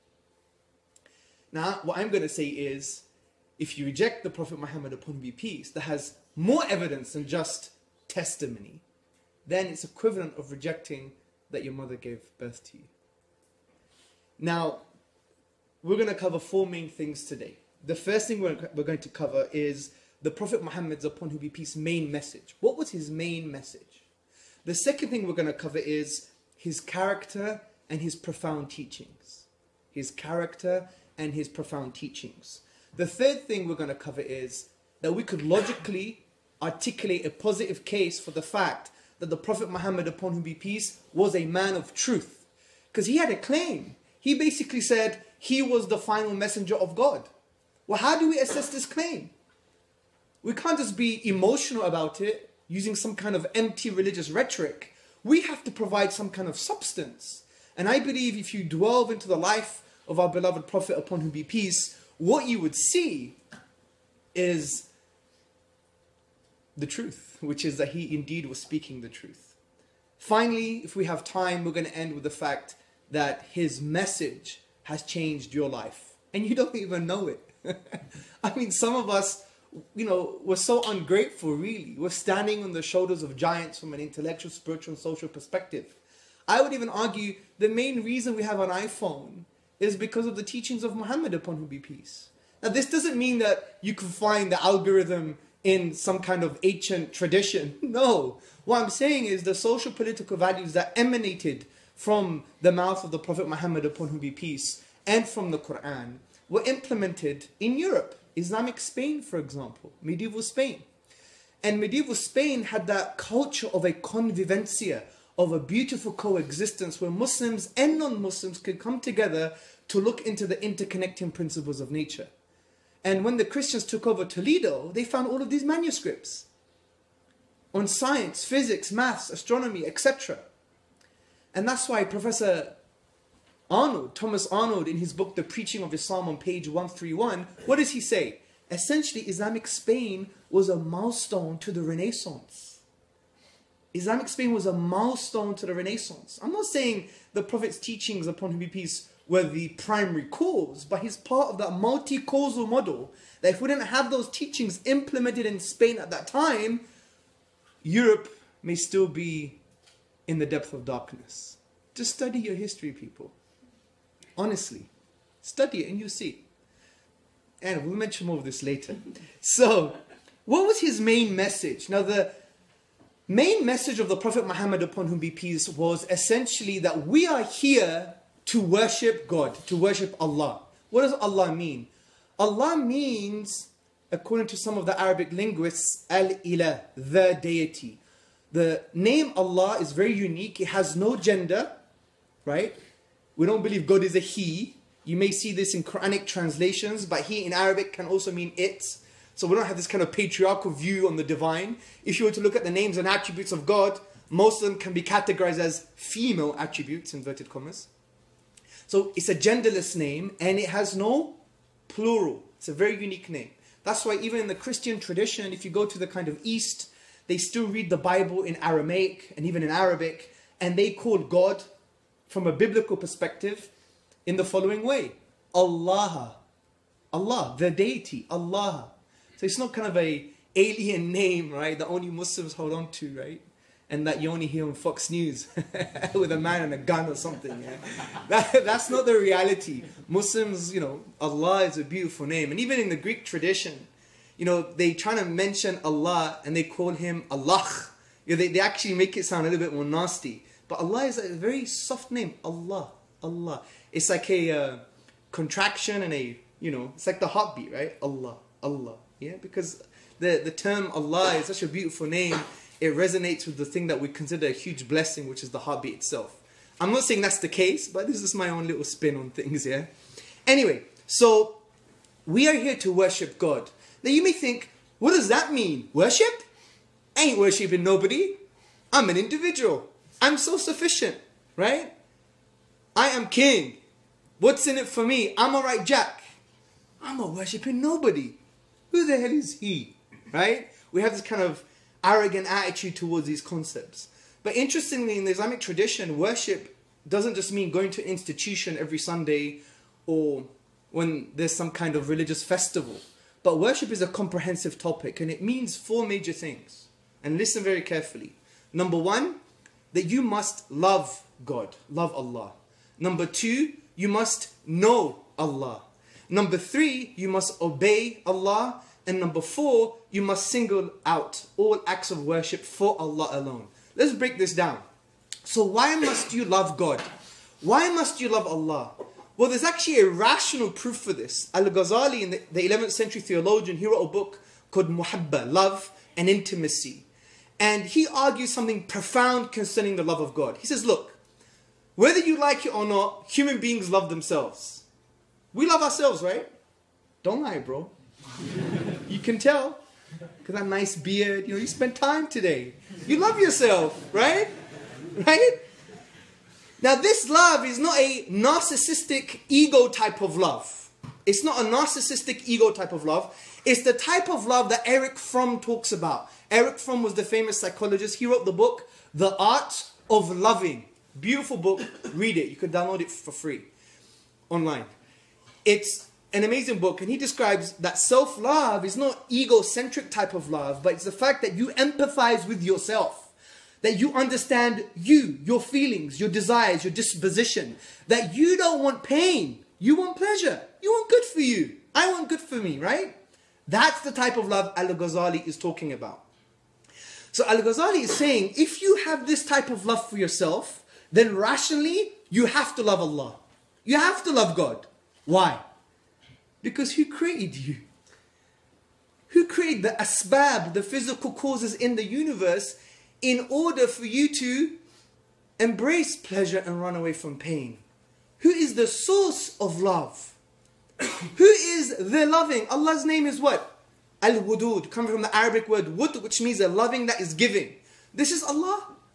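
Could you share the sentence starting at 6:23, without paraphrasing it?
That you understand you, your feelings, your desires, your disposition.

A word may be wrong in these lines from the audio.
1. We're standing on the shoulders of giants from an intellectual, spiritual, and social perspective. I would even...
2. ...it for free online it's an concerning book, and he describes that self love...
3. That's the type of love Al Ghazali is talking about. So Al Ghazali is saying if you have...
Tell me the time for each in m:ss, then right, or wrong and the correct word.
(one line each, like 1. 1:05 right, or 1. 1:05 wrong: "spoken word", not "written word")
1. 1:21 right
2. 6:12 wrong: "amazing", not "concerning"
3. 6:33 right.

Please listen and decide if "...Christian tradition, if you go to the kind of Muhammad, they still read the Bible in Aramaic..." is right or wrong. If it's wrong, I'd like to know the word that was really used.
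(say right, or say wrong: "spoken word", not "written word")
wrong: "East", not "Muhammad".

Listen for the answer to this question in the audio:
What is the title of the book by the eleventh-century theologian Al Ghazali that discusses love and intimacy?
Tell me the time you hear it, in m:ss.
5:34.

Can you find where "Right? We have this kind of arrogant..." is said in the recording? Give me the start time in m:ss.
4:50.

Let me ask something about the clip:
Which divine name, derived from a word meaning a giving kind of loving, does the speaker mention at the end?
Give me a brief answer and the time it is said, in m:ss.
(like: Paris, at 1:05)
Al Wudud, at 7:04.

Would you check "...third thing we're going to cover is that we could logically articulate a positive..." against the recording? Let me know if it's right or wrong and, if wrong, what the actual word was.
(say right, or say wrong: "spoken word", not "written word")
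right.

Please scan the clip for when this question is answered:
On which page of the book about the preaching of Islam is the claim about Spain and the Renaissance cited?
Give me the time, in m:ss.
2:16.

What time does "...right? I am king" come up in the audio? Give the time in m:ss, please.
4:41.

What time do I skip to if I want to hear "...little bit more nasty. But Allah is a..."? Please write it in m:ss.
4:09.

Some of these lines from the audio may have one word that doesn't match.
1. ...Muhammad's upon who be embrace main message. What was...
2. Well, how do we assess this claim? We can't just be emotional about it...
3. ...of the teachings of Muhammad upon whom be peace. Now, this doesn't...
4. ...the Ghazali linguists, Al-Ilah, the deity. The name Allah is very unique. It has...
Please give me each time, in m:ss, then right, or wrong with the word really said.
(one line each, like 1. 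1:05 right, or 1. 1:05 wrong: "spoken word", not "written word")
1. 0:20 wrong: "peace", not "embrace"
2. 0:47 right
3. 1:30 right
4. 3:04 wrong: "Arabic", not "Ghazali".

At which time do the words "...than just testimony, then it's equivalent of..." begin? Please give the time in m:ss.
0:07.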